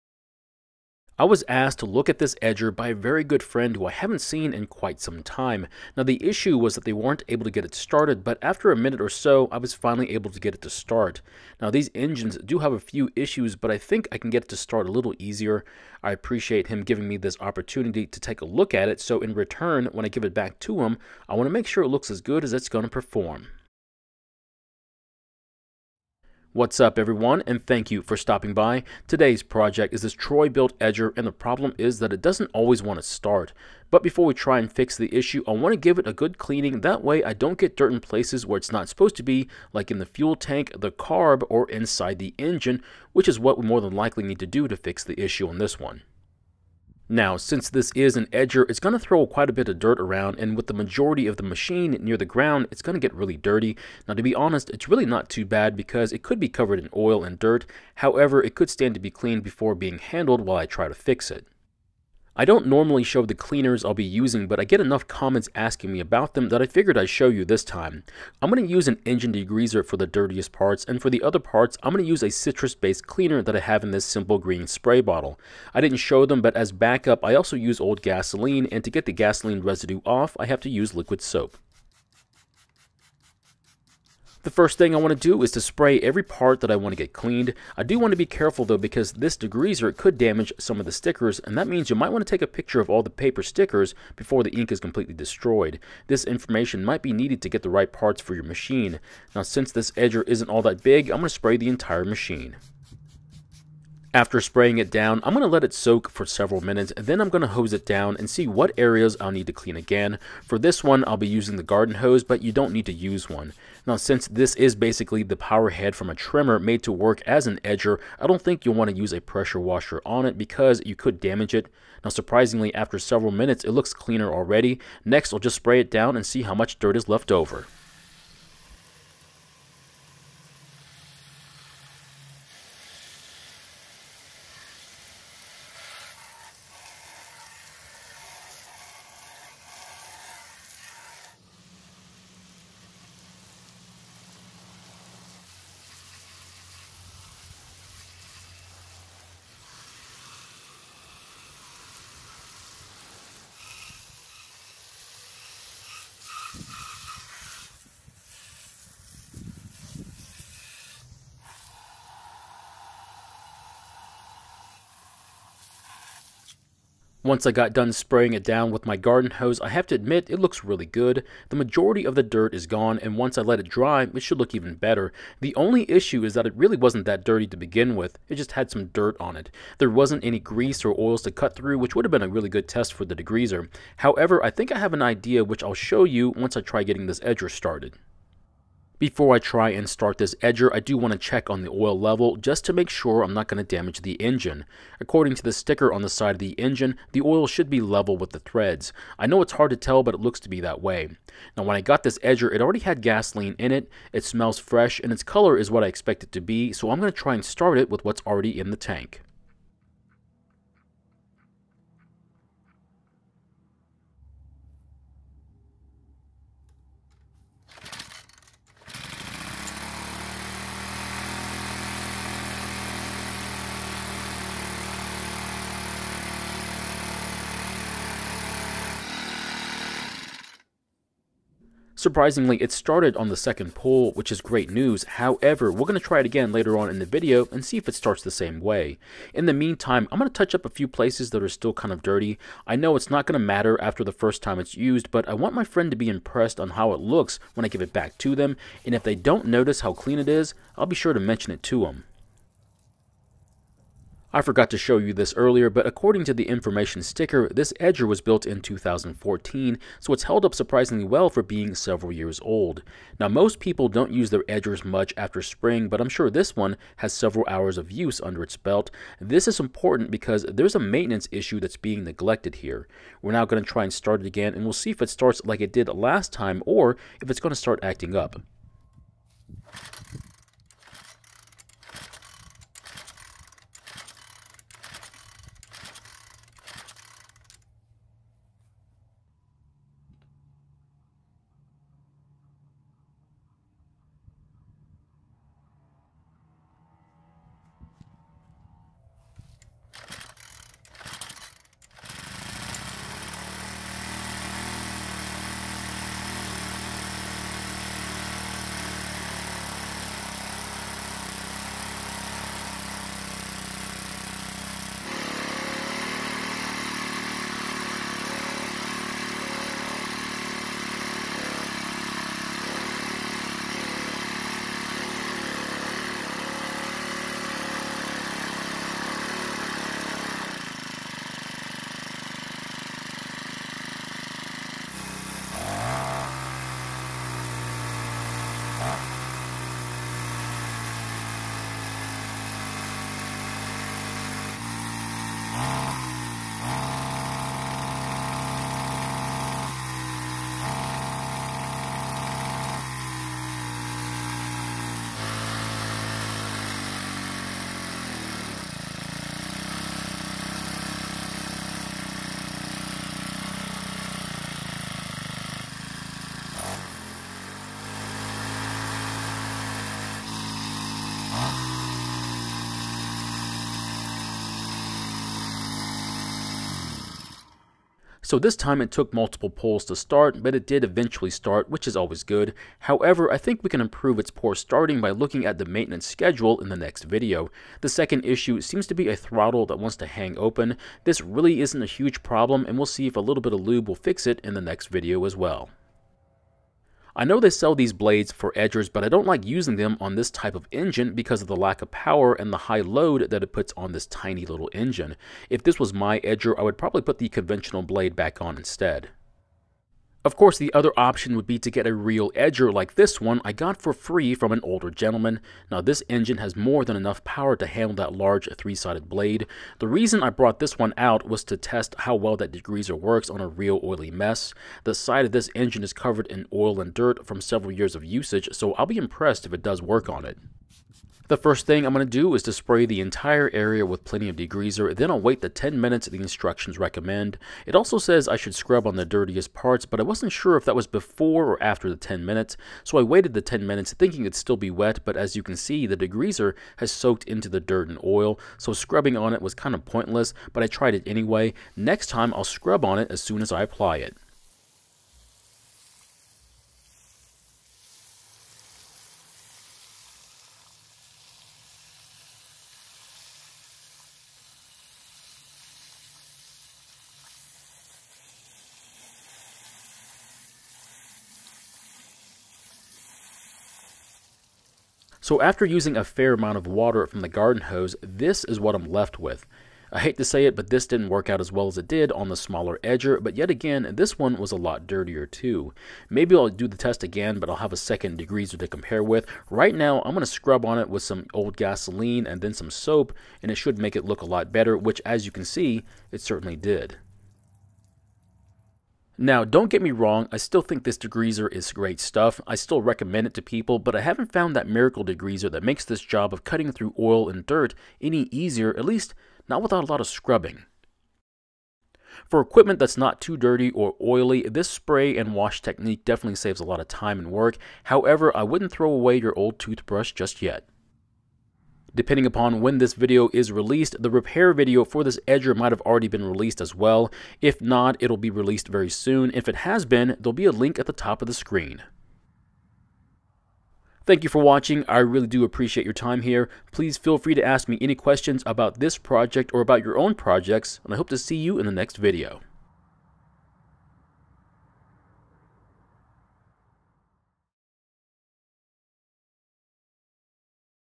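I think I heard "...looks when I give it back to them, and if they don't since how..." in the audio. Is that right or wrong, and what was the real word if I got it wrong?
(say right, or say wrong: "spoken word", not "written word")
wrong: "notice", not "since".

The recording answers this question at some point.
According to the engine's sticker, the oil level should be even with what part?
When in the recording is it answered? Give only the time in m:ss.
3:18.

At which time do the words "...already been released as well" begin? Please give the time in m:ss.
8:45.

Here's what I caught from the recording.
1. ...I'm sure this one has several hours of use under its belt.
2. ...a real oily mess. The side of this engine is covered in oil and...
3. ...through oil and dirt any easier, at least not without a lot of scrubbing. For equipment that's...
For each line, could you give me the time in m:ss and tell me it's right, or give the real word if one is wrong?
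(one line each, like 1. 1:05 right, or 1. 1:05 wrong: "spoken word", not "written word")
1. 4:25 right
2. 7:03 right
3. 8:26 right.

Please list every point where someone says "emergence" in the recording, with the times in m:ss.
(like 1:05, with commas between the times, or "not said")
not said.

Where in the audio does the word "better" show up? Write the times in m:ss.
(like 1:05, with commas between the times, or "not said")
2:54, 8:14.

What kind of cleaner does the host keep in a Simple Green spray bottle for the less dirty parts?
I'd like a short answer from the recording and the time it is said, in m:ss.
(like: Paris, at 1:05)
citrus-based cleaner, at 1:12.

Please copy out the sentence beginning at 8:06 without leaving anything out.
Maybe I'll do the test again, but I'll have a second degreaser to compare with.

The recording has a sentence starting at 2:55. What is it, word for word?
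The only issue is that it really wasn't that dirty to begin with, it just had some dirt on it.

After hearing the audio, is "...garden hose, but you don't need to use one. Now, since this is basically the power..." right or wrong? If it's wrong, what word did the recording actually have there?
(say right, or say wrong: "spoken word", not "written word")
right.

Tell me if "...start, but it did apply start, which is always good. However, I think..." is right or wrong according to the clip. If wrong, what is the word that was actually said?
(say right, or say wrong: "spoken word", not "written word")
wrong: "eventually", not "apply".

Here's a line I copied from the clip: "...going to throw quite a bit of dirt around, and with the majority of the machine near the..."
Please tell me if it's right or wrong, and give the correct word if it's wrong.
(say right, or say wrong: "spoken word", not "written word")
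right.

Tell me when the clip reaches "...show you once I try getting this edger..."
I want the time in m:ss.
3:05.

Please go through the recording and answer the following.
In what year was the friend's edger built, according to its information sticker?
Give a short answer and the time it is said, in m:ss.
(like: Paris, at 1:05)
2014, at 4:18.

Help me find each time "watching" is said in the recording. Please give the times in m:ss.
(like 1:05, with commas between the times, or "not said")
8:54.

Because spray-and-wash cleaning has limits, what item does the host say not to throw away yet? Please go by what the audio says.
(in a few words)
old toothbrush.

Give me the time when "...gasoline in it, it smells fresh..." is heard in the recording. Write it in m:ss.
3:23.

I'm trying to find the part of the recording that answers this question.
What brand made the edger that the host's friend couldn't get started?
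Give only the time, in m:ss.
0:30.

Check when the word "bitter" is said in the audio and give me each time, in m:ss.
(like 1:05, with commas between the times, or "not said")
not said.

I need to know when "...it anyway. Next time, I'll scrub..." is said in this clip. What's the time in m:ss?
7:30.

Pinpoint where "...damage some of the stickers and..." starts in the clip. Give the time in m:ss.
1:30.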